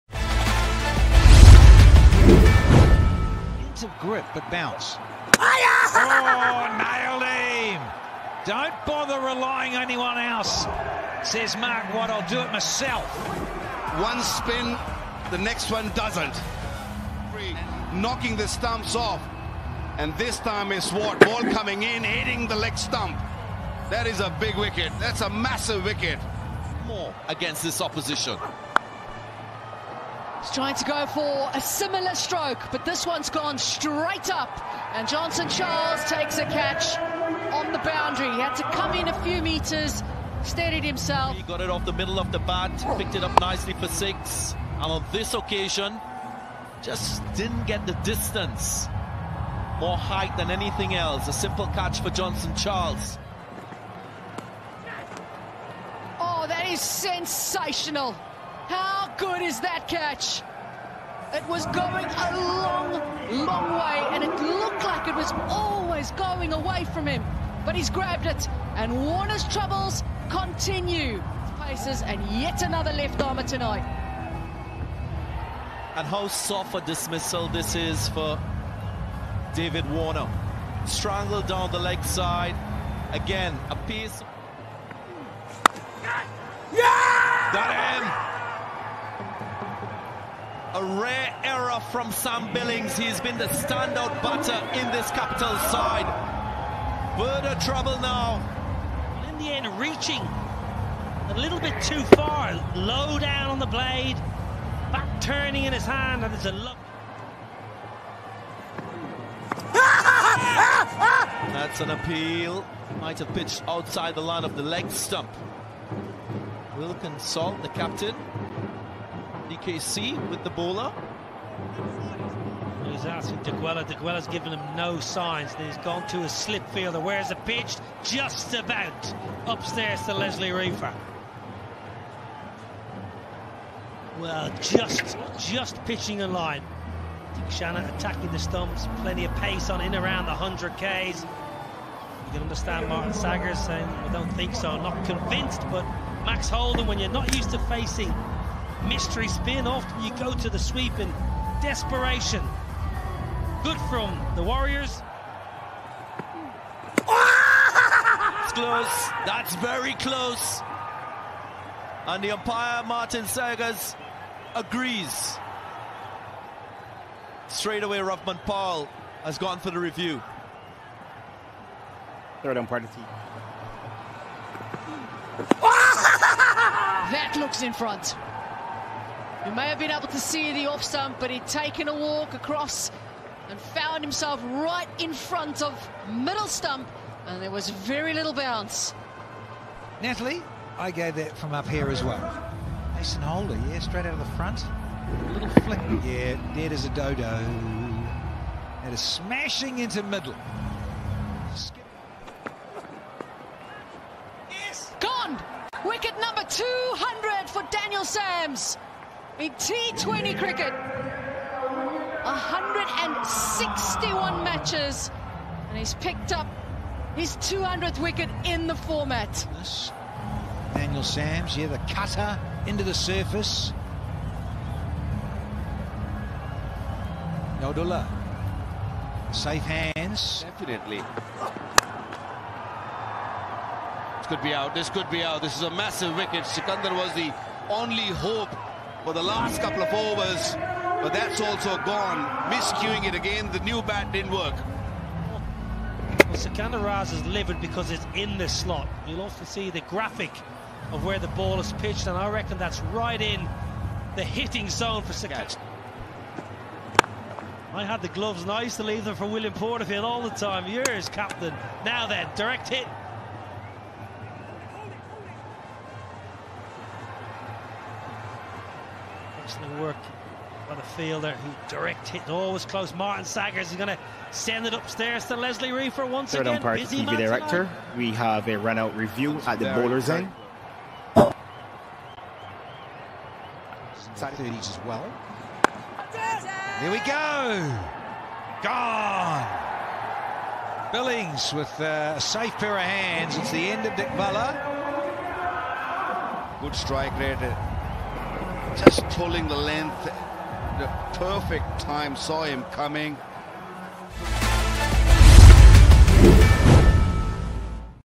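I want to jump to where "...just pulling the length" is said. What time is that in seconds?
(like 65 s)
298 s.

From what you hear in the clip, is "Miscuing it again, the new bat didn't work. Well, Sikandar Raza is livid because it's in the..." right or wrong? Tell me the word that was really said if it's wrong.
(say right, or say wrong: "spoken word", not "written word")
right.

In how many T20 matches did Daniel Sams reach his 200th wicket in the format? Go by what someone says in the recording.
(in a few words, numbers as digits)
161.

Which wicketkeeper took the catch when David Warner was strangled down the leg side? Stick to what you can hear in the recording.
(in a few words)
Sam Billings.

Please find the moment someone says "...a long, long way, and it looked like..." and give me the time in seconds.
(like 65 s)
62 s.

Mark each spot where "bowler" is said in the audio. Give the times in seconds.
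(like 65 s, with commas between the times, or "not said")
120 s, 279 s.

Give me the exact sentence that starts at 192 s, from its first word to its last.
Mason Holder, yeah, straight out of the front.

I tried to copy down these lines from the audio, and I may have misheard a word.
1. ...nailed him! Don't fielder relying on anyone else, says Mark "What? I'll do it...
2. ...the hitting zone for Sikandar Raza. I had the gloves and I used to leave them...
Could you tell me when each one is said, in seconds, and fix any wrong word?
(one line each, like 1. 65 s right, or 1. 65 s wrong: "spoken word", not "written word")
1. 6 s wrong: "bother", not "fielder"
2. 254 s right.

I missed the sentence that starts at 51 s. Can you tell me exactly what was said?
A simple catch for Johnson Charles.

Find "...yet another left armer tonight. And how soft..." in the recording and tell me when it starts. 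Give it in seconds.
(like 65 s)
72 s.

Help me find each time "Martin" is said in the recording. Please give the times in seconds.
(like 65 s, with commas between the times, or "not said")
142 s, 162 s, 272 s.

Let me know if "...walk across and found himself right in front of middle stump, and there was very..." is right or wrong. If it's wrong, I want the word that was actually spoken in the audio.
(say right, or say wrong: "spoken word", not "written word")
right.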